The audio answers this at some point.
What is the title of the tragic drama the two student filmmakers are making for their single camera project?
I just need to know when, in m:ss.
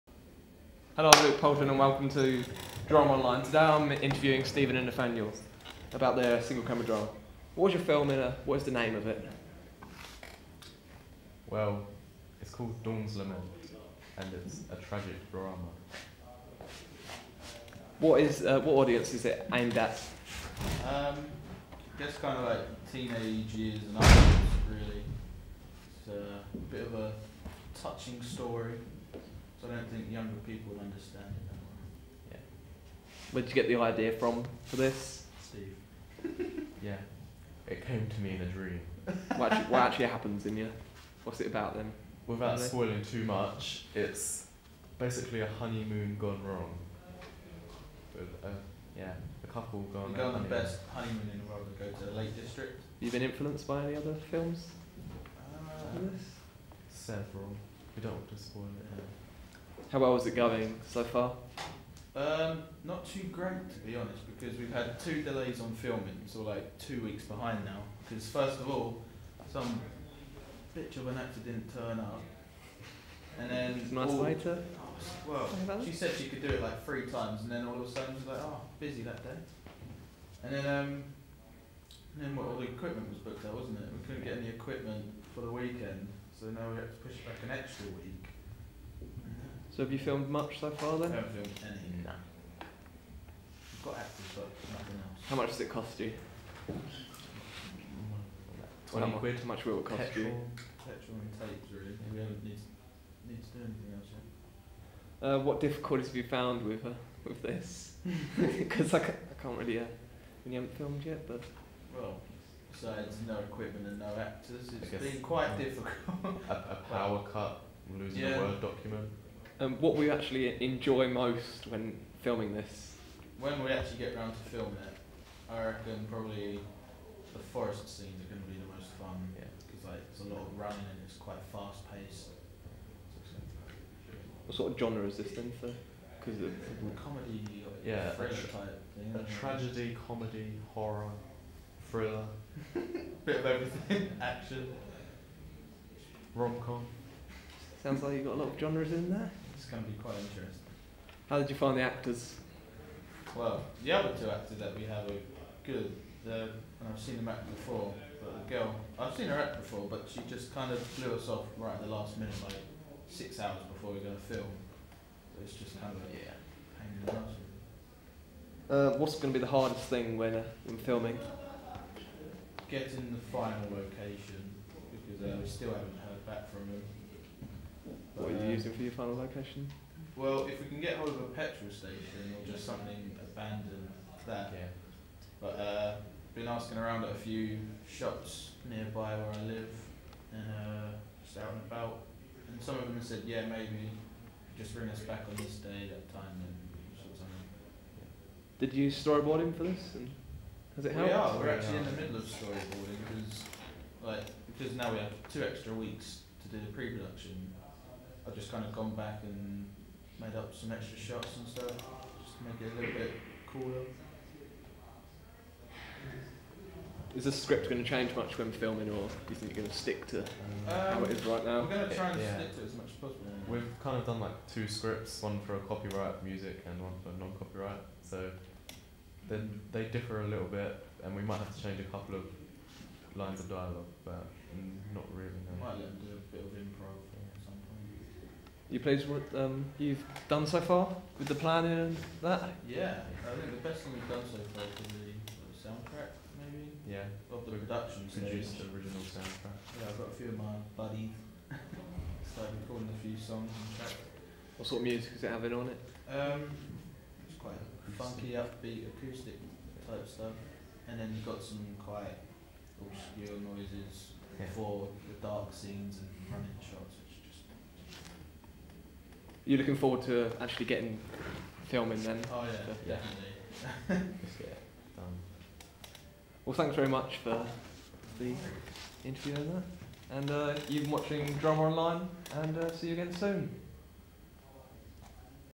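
0:12.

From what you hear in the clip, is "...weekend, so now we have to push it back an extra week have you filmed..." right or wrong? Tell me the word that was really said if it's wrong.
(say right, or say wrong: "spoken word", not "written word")
right.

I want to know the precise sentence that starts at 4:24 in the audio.
for the dark scenes and running shots.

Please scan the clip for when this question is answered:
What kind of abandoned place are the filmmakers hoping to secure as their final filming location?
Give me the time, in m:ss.
3:01.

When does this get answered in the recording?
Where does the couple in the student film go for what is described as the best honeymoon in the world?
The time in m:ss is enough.
0:52.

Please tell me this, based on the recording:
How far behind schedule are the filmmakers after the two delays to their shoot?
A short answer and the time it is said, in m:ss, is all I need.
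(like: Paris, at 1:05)
2 weeks, at 1:06.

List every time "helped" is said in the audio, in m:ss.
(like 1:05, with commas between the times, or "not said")
3:20.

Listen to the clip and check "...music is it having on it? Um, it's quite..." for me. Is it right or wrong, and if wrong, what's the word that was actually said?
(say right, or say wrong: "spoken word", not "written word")
right.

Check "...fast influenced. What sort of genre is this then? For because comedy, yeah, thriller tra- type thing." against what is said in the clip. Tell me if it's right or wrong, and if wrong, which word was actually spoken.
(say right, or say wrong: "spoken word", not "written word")
wrong: "paced", not "influenced".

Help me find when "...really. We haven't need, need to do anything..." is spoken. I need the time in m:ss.
1:41.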